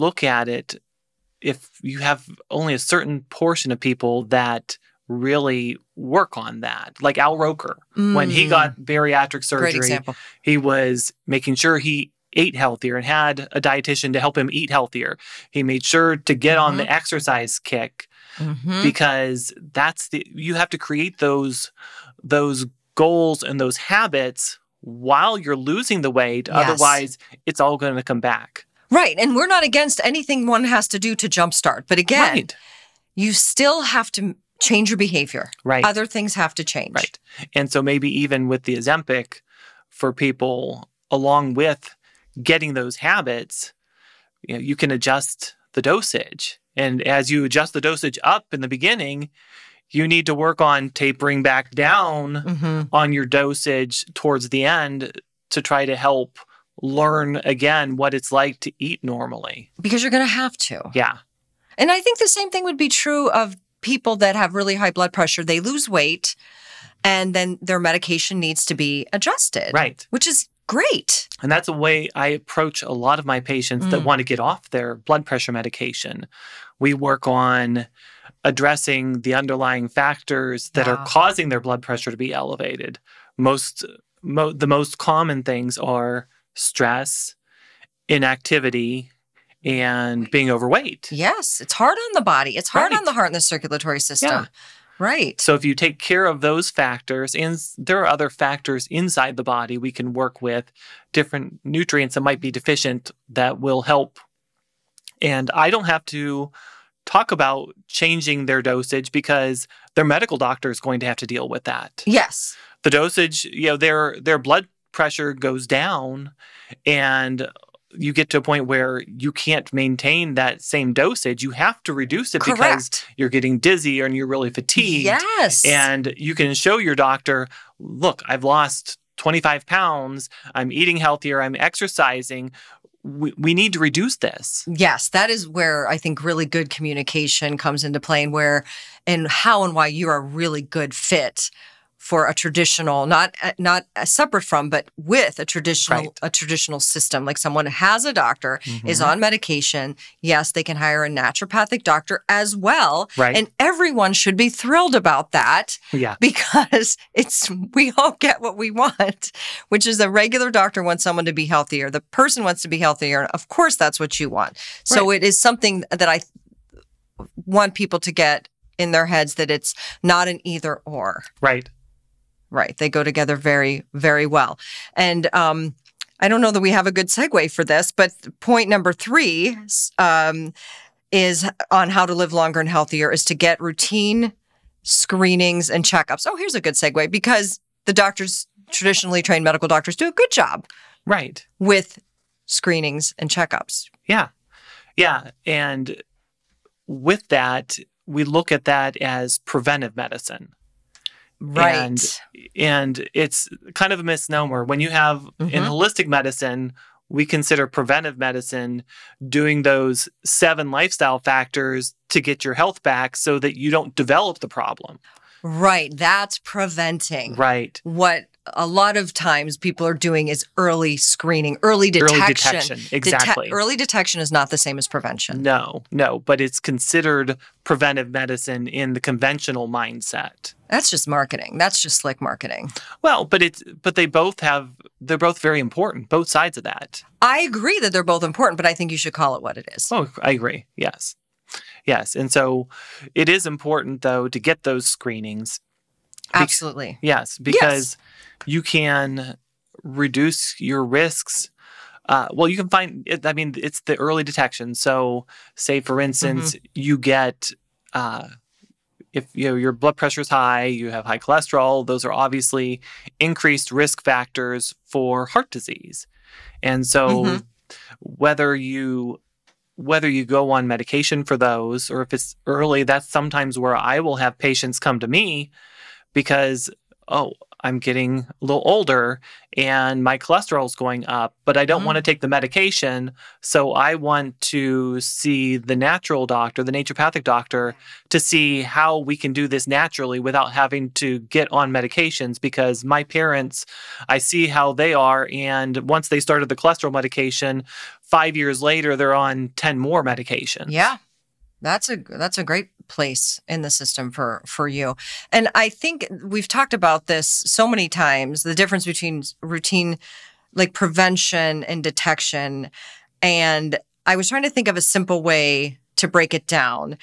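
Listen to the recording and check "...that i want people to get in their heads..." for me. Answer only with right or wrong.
right.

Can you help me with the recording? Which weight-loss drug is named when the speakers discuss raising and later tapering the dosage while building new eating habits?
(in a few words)
Ozempic.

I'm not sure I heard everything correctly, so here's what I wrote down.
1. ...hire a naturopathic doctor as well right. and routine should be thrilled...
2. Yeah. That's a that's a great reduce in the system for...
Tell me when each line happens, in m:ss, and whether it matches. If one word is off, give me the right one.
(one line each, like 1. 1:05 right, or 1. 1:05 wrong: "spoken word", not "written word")
1. 2:30 wrong: "everyone", not "routine"
2. 5:00 wrong: "place", not "reduce".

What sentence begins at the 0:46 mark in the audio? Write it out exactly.
And as you adjust the dosage up in the beginning, you need to work on tapering back down mm-hmm.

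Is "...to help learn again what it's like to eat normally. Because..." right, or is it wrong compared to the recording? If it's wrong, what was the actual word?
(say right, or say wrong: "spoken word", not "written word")
right.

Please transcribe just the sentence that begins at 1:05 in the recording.
They lose weight and then their medication needs to be adjusted.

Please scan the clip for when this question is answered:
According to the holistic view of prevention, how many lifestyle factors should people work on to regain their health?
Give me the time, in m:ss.
3:30.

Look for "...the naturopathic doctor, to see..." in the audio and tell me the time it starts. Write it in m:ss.
4:46.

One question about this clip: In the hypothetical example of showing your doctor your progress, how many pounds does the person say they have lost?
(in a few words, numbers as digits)
25 pounds.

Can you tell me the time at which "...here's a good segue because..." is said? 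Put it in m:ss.
3:06.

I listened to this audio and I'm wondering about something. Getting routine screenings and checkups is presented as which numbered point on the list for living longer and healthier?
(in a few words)
3.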